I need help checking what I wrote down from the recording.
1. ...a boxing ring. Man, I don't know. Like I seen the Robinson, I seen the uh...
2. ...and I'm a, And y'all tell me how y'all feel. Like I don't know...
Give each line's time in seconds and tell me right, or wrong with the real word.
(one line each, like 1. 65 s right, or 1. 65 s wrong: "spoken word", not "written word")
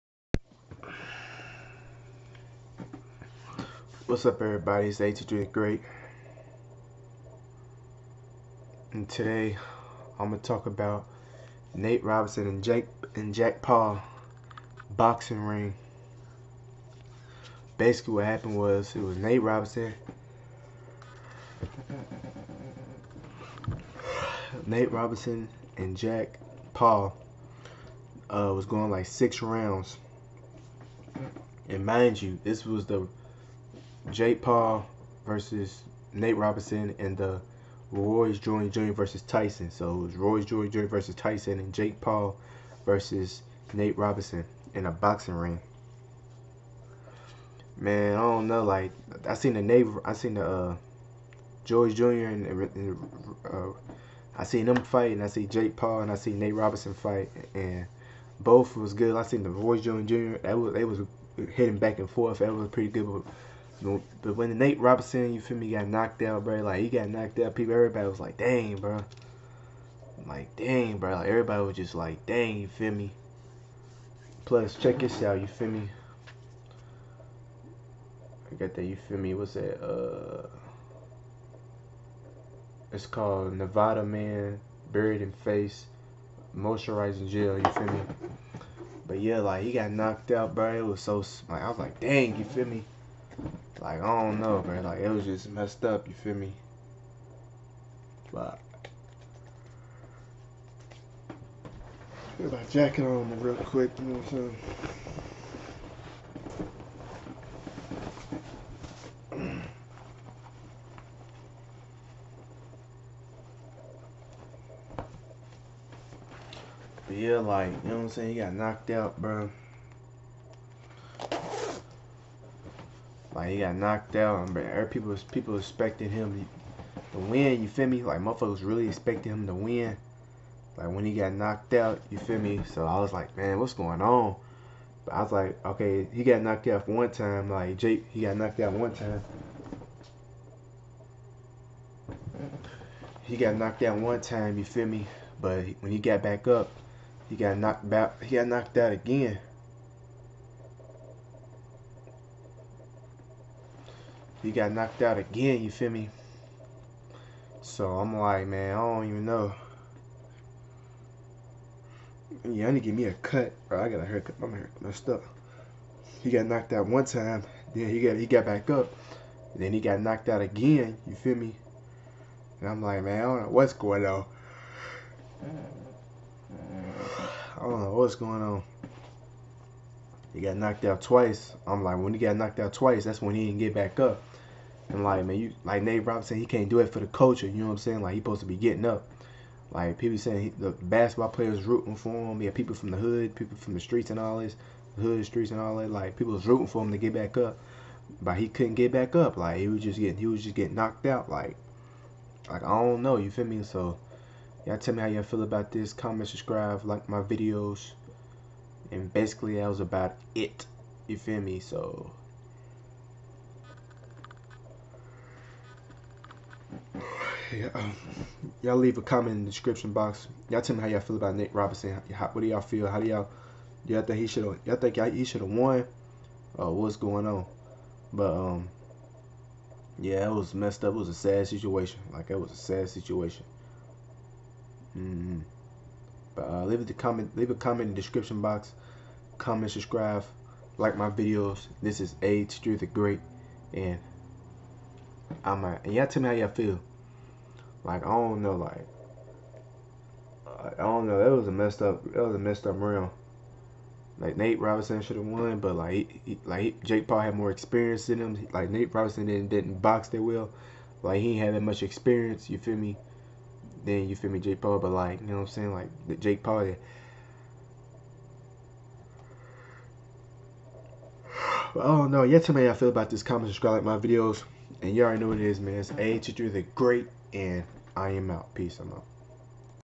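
1. 44 s wrong: "Nate", not "Robinson"
2. 243 s right.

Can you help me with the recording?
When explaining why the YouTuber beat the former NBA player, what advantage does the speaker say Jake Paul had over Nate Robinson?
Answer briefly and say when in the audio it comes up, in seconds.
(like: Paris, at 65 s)
more experience, at 257 s.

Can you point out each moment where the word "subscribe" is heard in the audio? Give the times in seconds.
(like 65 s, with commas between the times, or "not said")
206 s, 239 s, 273 s.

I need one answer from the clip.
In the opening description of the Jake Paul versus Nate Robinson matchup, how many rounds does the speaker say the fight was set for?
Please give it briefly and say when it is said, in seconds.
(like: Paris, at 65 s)
6, at 29 s.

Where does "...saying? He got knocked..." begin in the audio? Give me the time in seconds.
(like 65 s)
118 s.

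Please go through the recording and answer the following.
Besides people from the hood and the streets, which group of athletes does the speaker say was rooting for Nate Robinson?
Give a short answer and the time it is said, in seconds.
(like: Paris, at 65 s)
basketball players, at 190 s.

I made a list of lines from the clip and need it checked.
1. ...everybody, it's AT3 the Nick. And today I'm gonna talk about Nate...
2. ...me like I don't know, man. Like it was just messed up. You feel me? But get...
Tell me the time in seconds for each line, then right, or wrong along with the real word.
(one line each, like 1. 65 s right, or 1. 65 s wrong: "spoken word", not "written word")
1. 4 s wrong: "Great", not "Nick"
2. 92 s right.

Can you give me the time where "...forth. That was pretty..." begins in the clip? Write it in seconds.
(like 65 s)
62 s.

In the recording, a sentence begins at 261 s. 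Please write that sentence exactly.
Like he ain't had that much experience.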